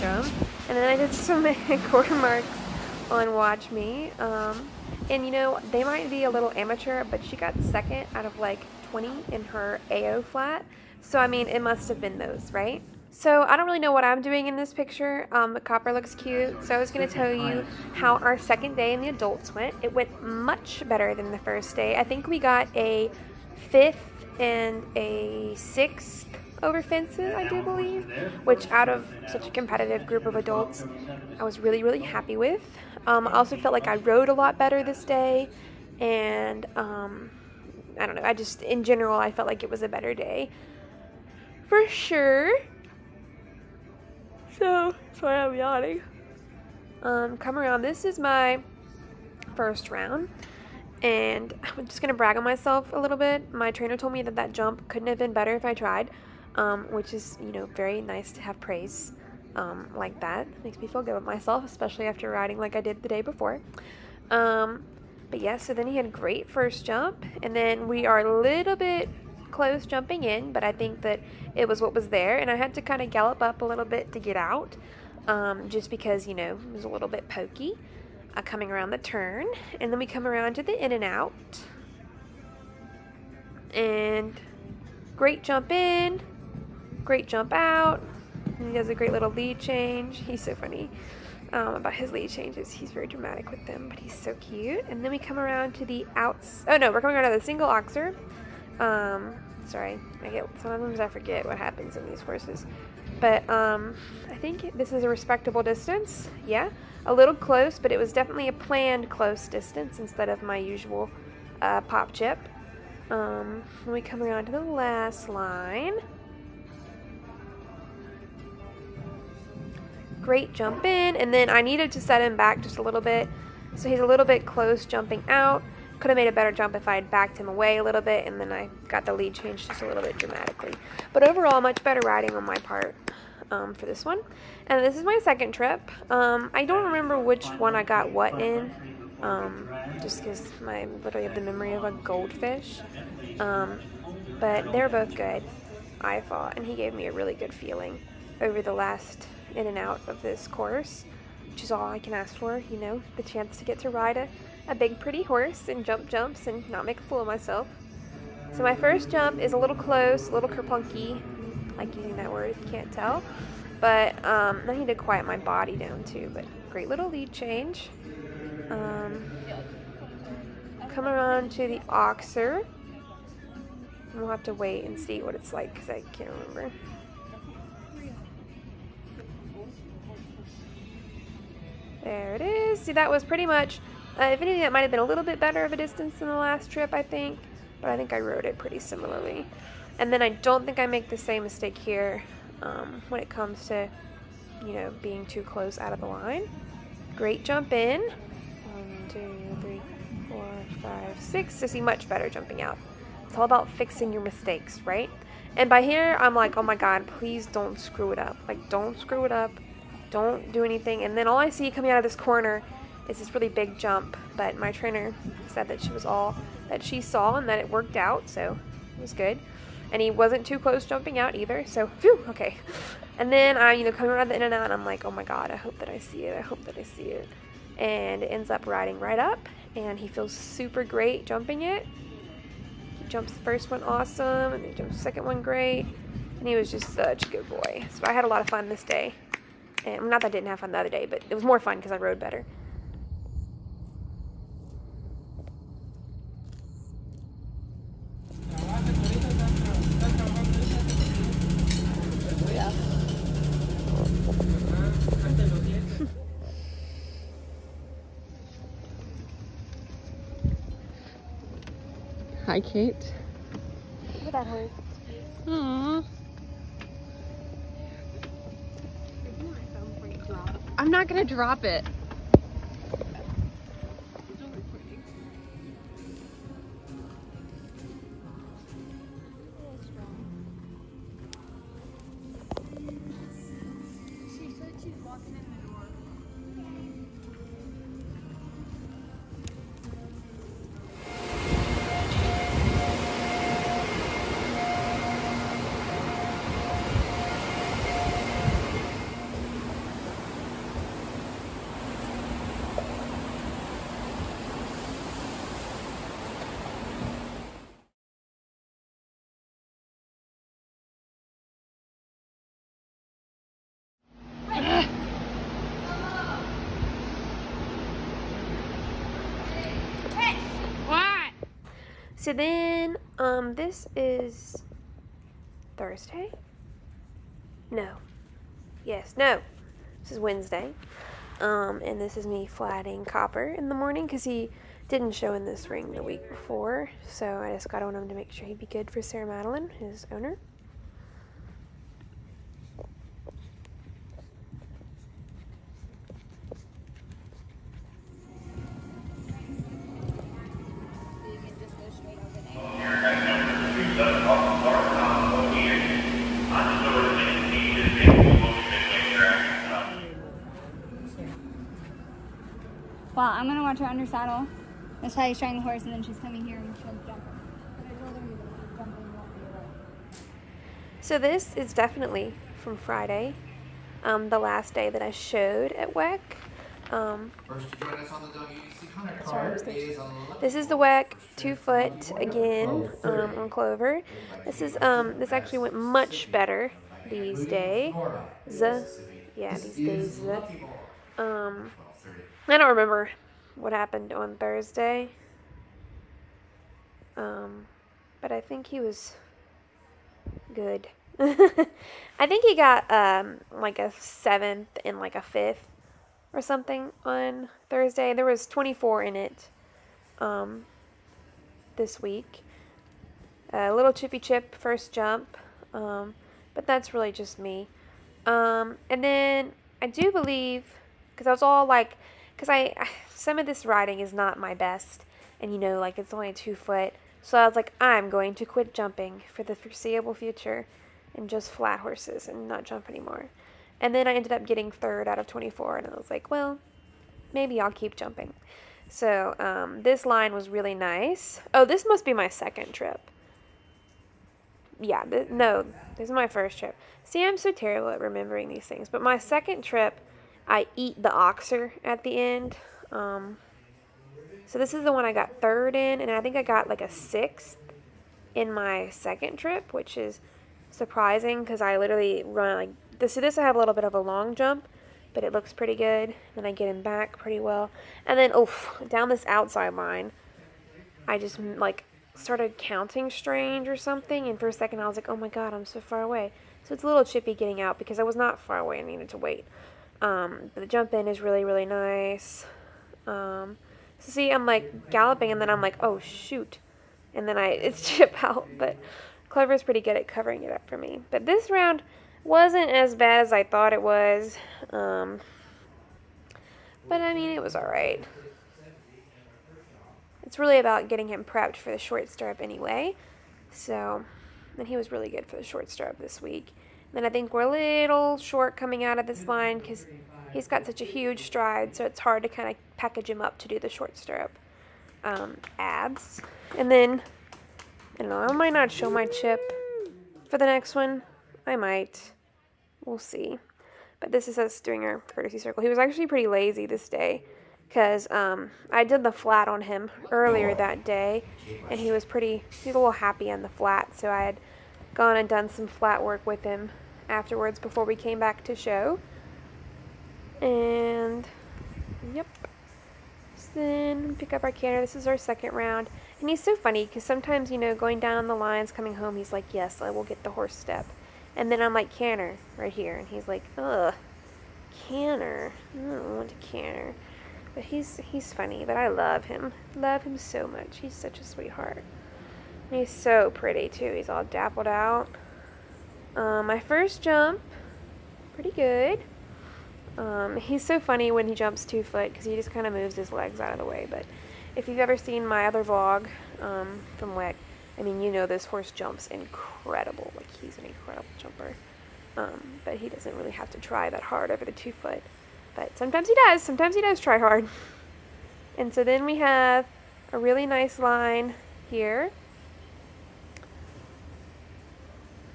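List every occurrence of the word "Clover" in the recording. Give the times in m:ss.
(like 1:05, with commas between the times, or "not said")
6:23, 8:09.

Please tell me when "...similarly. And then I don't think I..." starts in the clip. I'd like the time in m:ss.
3:08.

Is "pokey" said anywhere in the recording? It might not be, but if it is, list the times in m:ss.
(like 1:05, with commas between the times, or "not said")
1:17.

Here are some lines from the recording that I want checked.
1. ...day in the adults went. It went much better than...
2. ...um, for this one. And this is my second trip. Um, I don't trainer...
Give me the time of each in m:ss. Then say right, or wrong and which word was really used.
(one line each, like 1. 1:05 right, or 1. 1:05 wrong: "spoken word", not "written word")
1. 0:18 right
2. 2:13 wrong: "remember", not "trainer".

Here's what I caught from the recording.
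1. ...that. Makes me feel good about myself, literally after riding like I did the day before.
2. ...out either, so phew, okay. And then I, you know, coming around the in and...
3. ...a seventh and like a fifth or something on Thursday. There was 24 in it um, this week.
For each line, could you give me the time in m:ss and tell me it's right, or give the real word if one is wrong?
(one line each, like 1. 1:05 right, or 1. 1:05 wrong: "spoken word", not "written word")
1. 1:00 wrong: "especially", not "literally"
2. 3:41 right
3. 6:43 right.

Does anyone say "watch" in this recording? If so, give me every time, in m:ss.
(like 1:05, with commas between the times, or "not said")
0:03, 6:03.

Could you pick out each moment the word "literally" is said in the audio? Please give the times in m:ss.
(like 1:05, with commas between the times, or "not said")
2:21, 7:41.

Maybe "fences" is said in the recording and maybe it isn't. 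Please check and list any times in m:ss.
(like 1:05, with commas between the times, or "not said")
0:26.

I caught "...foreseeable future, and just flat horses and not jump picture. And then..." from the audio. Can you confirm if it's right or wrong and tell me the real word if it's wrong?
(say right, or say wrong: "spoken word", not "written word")
wrong: "anymore", not "picture".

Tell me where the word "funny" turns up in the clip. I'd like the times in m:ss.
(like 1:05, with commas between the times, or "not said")
1:30, 9:06, 9:18, 9:30.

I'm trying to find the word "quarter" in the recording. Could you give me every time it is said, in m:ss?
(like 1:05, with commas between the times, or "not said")
0:01.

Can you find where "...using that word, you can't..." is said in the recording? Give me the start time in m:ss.
2:41.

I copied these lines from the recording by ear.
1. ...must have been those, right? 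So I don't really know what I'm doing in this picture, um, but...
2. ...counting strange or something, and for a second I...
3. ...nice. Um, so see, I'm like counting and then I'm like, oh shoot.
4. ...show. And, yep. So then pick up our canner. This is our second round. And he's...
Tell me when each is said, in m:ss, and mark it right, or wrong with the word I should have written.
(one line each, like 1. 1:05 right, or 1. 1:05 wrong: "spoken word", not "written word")
1. 0:11 right
2. 7:52 right
3. 8:01 wrong: "galloping", not "counting"
4. 8:58 right.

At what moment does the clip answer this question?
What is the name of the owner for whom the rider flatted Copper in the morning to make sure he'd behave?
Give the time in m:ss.
5:39.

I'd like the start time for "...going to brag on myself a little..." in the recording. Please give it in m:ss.
0:51.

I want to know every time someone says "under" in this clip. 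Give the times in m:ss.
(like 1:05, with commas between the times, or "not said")
6:03.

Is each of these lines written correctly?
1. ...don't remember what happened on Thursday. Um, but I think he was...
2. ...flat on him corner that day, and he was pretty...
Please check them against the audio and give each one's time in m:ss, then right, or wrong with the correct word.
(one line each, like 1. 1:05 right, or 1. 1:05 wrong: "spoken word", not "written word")
1. 6:32 right
2. 8:49 wrong: "earlier", not "corner".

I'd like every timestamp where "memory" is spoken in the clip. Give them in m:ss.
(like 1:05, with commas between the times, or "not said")
2:21.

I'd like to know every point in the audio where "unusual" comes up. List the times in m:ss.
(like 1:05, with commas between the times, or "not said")
not said.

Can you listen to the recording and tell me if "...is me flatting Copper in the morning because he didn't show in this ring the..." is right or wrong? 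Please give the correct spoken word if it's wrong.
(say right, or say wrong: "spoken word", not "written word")
right.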